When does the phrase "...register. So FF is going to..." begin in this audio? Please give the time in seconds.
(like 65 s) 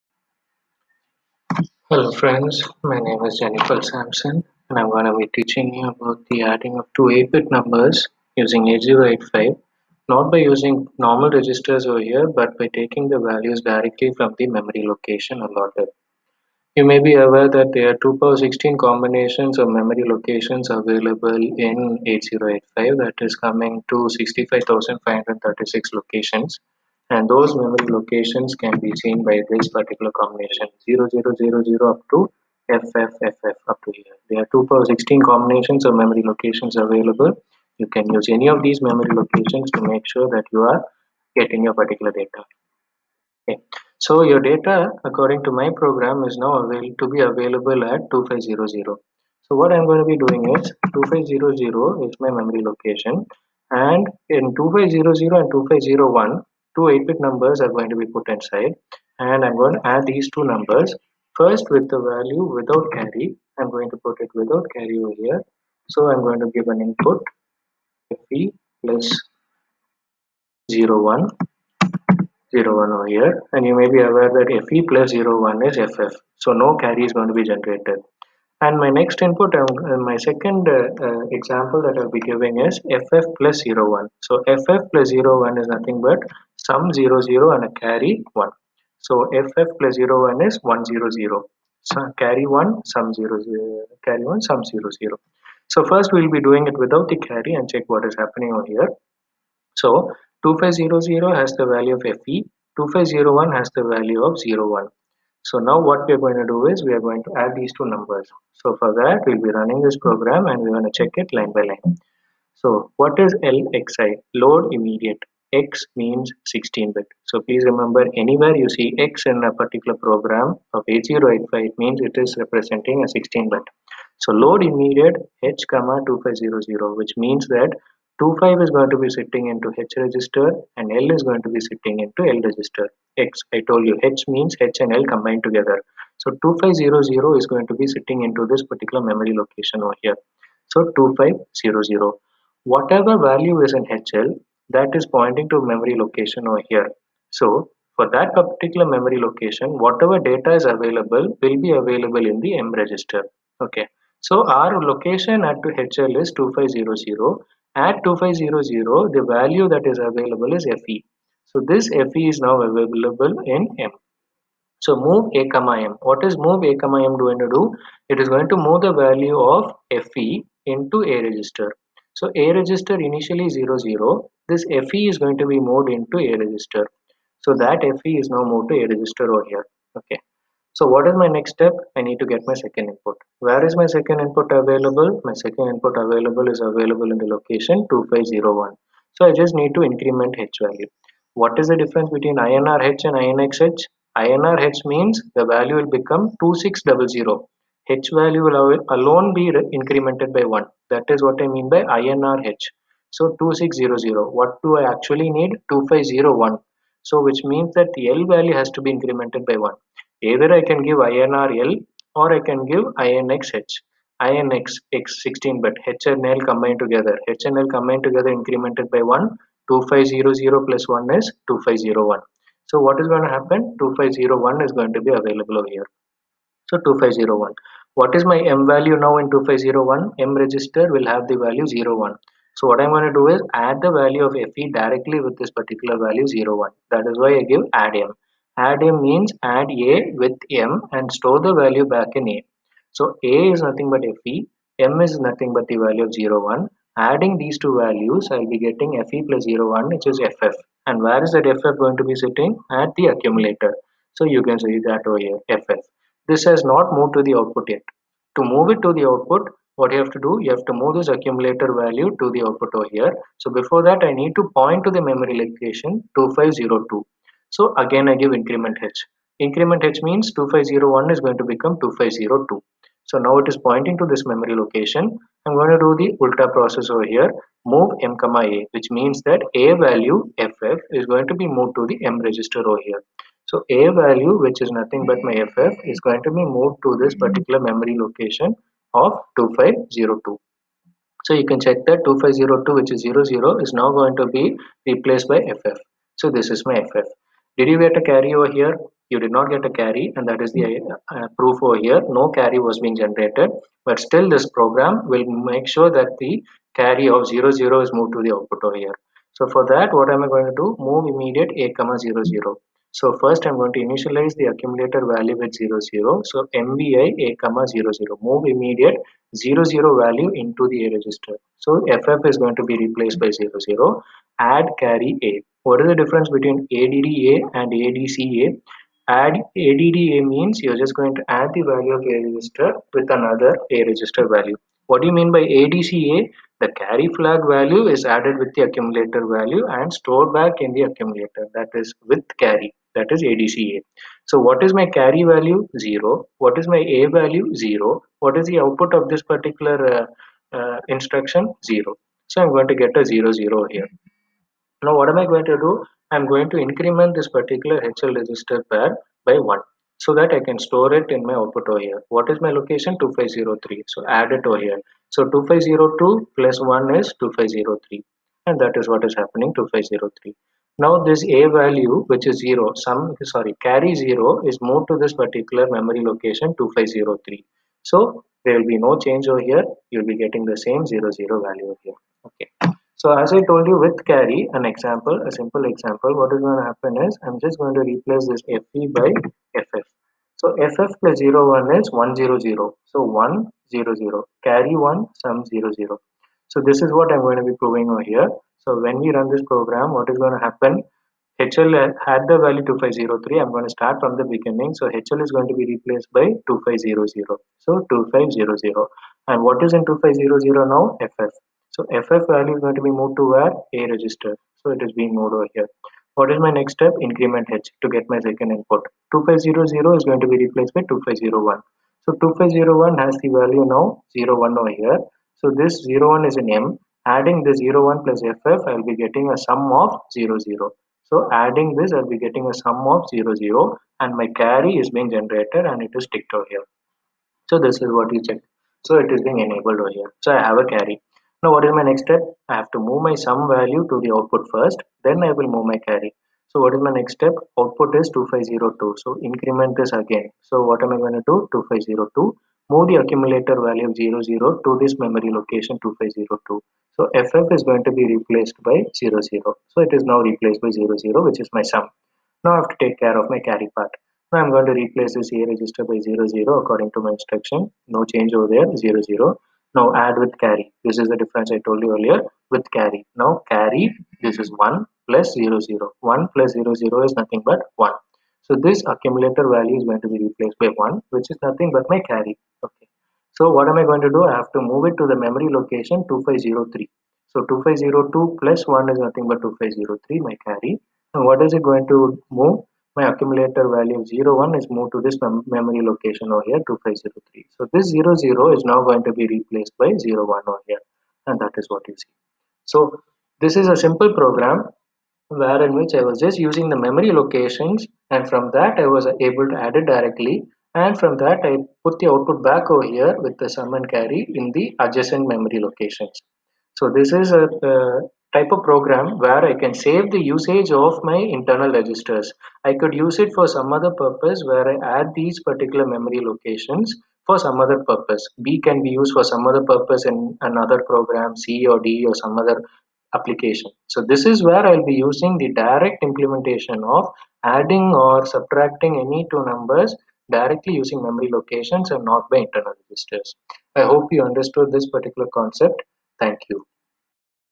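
320 s.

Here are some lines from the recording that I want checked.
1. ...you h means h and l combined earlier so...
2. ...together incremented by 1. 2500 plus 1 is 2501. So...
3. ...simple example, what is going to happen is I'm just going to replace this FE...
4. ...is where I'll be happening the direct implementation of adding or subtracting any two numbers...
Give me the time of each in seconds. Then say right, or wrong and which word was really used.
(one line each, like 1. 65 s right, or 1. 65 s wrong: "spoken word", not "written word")
1. 133 s wrong: "together", not "earlier"
2. 218 s right
3. 385 s right
4. 534 s wrong: "using", not "happening".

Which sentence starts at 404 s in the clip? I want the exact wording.
So HL is going to be replaced by 2500.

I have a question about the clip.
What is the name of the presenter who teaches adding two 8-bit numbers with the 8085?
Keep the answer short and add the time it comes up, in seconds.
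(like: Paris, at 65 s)
Jenyfal Sampson, at 3 s.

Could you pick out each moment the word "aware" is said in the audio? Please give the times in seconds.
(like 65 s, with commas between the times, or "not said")
17 s, 74 s.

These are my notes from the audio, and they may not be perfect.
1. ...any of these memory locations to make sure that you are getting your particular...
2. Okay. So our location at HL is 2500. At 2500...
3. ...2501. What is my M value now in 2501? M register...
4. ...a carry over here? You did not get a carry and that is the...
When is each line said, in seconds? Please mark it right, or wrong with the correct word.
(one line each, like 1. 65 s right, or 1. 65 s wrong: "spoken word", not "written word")
1. 38 s right
2. 153 s right
3. 226 s right
4. 297 s right.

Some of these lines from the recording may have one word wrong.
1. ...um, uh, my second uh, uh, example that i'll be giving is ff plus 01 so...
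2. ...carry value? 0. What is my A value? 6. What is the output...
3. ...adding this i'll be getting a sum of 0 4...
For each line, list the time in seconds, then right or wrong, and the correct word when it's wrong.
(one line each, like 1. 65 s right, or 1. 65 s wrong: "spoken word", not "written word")
1. 79 s right
2. 344 s wrong: "0", not "6"
3. 431 s wrong: "0", not "4".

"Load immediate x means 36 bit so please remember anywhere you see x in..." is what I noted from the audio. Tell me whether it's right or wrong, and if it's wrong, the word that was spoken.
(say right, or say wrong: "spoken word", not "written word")
wrong: "16", not "36".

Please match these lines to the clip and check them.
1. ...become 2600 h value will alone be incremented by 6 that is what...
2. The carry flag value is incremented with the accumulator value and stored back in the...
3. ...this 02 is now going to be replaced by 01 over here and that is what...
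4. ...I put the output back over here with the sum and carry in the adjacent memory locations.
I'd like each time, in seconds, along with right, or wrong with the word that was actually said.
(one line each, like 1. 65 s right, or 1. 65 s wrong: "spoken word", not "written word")
1. 195 s wrong: "1", not "6"
2. 336 s wrong: "added", not "incremented"
3. 497 s wrong: "00", not "02"
4. 511 s right.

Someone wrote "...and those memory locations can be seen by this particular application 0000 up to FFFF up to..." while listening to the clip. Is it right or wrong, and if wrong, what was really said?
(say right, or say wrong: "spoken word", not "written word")
wrong: "combination", not "application".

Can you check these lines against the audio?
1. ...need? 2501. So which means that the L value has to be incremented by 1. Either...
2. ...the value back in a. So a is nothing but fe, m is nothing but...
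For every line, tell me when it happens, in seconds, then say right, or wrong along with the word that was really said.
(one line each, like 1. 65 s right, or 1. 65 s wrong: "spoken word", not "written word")
1. 205 s right
2. 241 s right.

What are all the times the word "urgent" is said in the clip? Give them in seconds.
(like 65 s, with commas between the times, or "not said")
not said.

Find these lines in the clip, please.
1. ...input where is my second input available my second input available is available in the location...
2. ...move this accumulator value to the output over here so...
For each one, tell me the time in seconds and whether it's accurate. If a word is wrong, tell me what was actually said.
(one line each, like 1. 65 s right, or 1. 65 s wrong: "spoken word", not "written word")
1. 182 s right
2. 260 s right.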